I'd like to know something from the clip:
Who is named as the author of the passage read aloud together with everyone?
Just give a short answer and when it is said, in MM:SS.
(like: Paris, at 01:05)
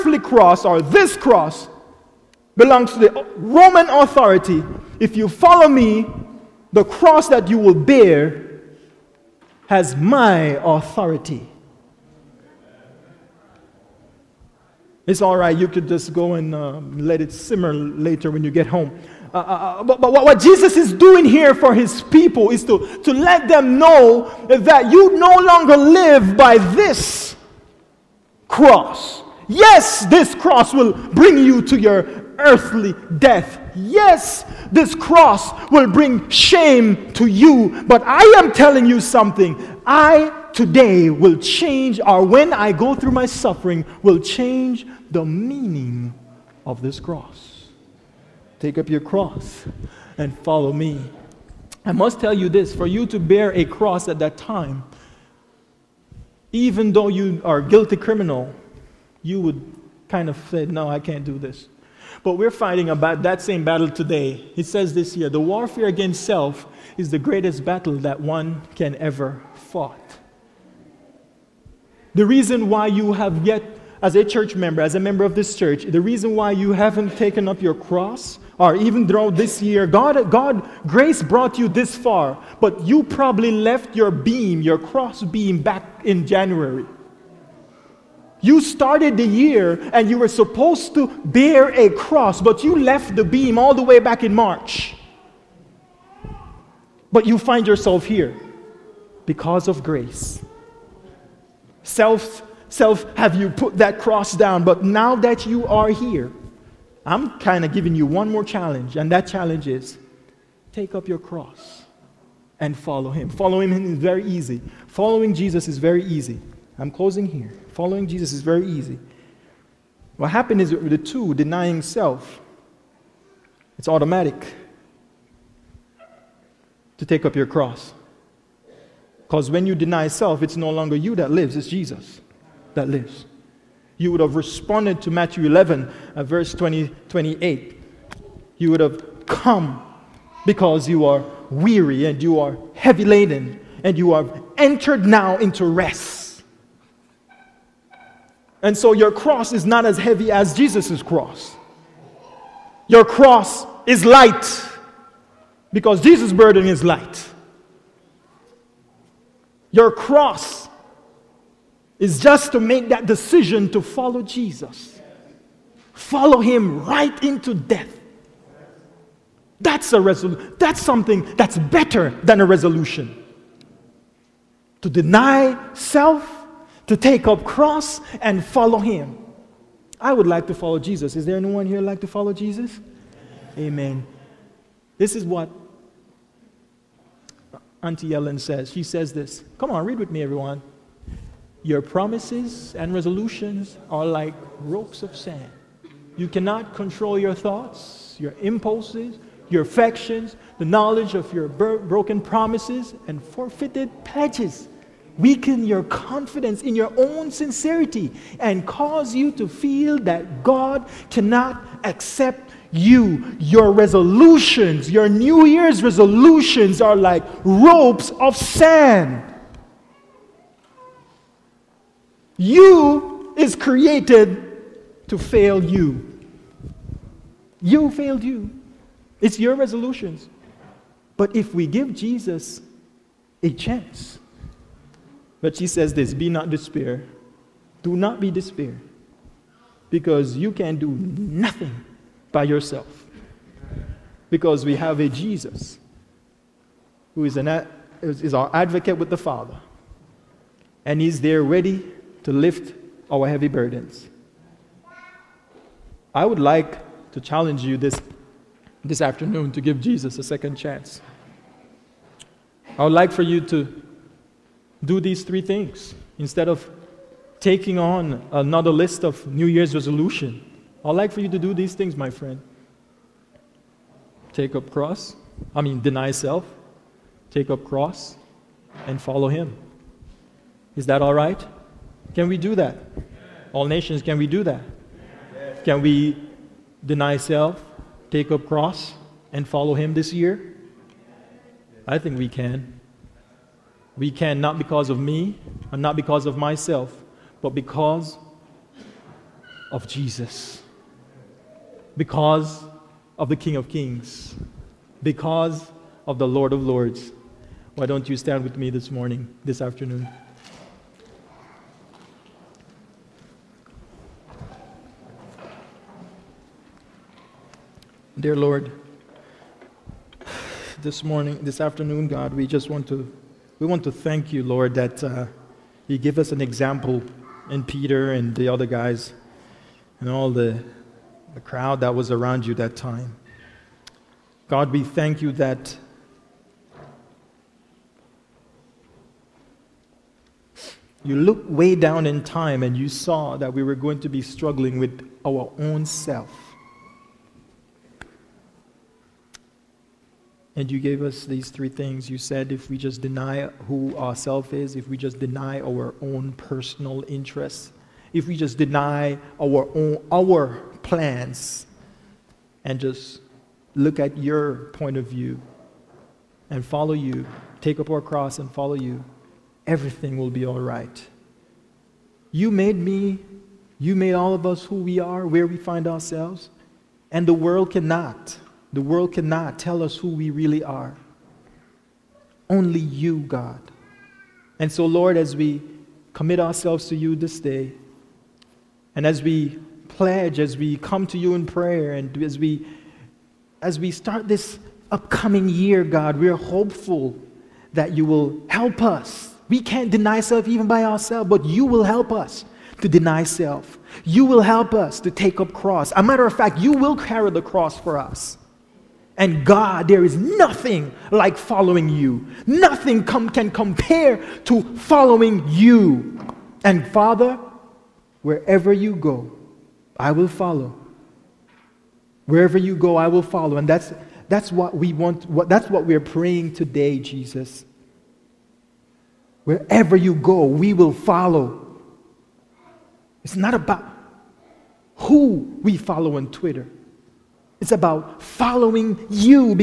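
Auntie Ellen, at 03:07.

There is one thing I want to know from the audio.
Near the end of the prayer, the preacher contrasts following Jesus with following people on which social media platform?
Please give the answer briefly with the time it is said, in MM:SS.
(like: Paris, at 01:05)
Twitter, at 07:16.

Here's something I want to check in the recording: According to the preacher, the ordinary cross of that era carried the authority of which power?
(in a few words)
Roman authority.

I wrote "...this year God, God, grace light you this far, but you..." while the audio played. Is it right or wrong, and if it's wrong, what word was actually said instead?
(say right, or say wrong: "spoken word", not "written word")
wrong: "brought", not "light".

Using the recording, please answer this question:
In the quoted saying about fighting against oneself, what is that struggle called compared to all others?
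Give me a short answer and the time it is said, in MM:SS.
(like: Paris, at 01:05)
the greatest battle, at 01:07.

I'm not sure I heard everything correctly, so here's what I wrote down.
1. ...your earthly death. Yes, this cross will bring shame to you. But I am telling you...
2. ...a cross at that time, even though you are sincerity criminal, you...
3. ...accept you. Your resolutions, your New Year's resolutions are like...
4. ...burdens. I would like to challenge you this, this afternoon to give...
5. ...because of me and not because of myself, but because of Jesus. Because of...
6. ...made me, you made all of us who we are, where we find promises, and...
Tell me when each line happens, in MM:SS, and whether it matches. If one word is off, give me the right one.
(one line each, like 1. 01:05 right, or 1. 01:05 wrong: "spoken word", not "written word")
1. 00:31 right
2. 00:53 wrong: "guilty", not "sincerity"
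3. 03:31 right
4. 04:13 right
5. 04:54 right
6. 06:12 wrong: "ourselves", not "promises".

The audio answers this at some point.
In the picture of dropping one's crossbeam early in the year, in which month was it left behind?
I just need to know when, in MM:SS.
01:34.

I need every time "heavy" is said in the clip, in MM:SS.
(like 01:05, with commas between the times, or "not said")
02:22, 02:29, 04:13.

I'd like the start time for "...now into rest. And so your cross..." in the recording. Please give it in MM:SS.
02:25.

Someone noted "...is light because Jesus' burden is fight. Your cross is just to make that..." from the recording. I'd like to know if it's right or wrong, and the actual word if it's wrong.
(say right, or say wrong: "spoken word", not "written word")
wrong: "light", not "fight".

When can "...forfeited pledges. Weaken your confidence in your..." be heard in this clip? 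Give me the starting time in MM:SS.
03:23.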